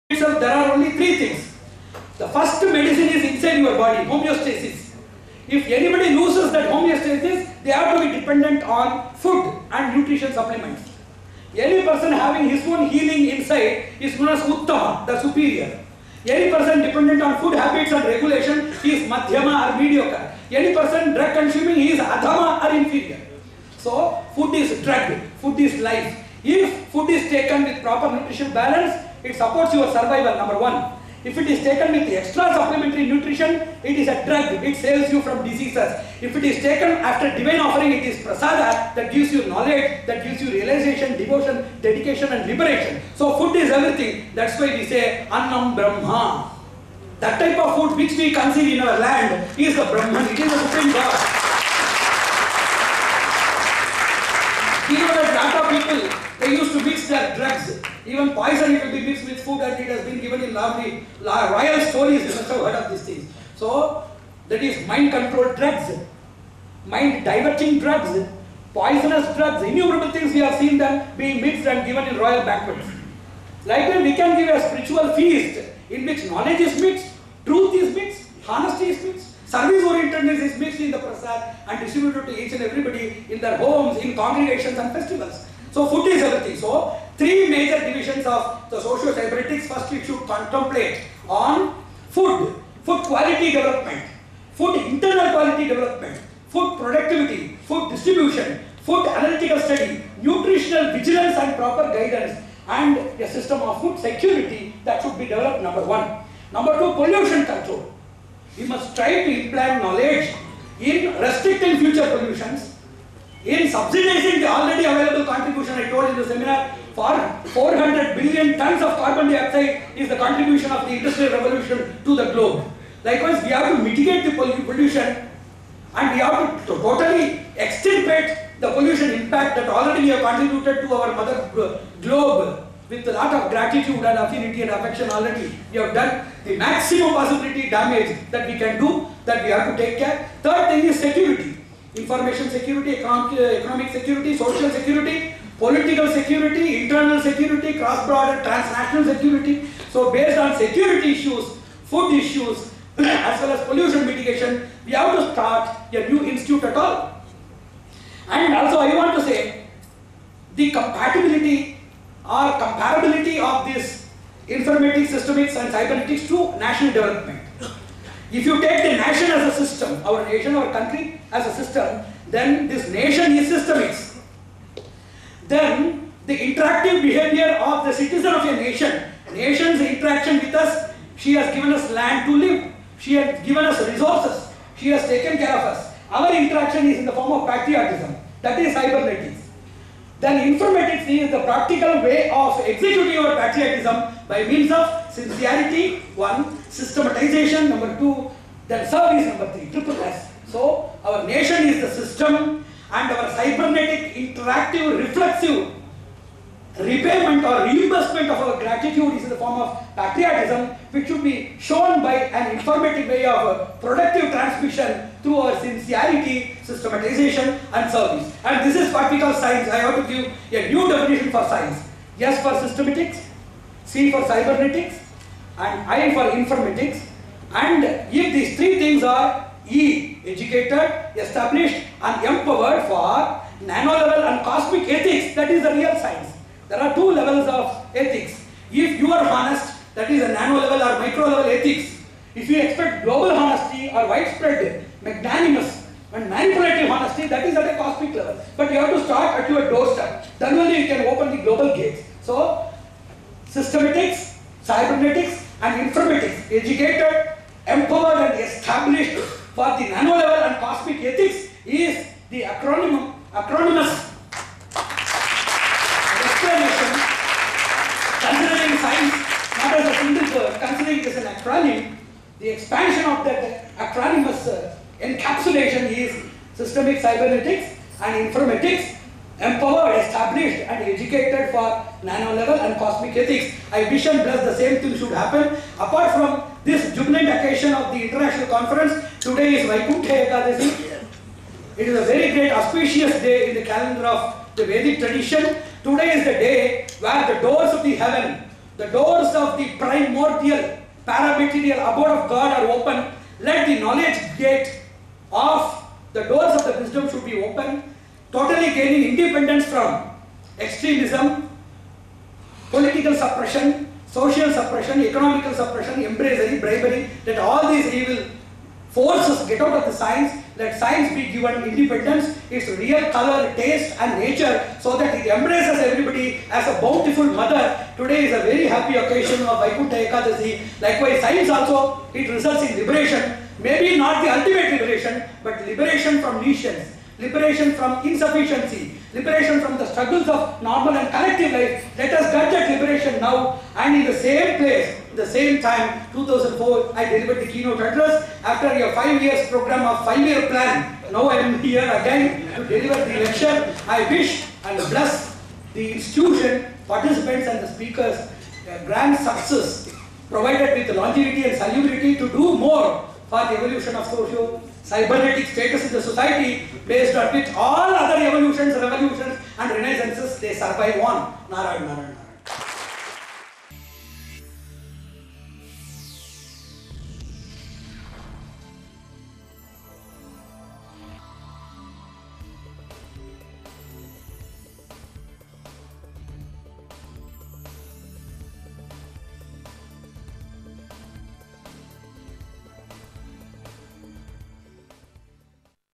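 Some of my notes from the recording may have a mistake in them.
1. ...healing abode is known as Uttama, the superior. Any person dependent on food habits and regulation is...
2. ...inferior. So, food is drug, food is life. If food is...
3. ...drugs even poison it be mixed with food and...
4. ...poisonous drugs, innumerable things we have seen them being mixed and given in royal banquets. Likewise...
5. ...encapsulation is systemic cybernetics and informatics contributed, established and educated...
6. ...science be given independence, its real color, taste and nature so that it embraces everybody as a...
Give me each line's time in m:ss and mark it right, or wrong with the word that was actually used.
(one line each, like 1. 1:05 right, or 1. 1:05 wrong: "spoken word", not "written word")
1. 0:12 wrong: "inside", not "abode"
2. 0:22 right
3. 0:57 right
4. 1:08 right
5. 4:35 wrong: "empowered", not "contributed"
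6. 5:20 right.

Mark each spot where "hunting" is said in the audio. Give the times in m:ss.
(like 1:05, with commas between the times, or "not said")
not said.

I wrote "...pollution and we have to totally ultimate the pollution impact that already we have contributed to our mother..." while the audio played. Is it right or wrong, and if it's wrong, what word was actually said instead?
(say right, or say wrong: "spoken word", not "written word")
wrong: "extirpate", not "ultimate".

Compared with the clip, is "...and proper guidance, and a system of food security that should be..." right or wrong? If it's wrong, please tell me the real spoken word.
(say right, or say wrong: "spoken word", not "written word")
right.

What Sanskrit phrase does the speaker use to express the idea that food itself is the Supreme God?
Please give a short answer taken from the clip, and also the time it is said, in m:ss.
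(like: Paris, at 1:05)
Annam Brahma, at 0:45.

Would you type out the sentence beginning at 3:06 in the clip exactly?
Our interaction is in the form of patriotism, that is cybernetics.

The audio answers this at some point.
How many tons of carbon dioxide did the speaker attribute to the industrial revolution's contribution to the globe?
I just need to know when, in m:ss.
1:57.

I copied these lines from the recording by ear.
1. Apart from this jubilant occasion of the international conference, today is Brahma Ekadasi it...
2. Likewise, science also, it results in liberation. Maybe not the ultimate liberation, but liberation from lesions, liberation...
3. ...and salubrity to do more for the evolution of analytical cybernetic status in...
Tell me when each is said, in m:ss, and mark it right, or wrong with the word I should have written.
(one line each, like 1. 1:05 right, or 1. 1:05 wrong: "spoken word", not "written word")
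1. 4:45 wrong: "Vaikuntha", not "Brahma"
2. 5:30 right
3. 6:01 wrong: "social", not "analytical".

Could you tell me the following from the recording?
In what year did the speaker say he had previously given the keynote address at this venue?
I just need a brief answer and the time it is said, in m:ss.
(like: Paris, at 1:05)
2004, at 5:46.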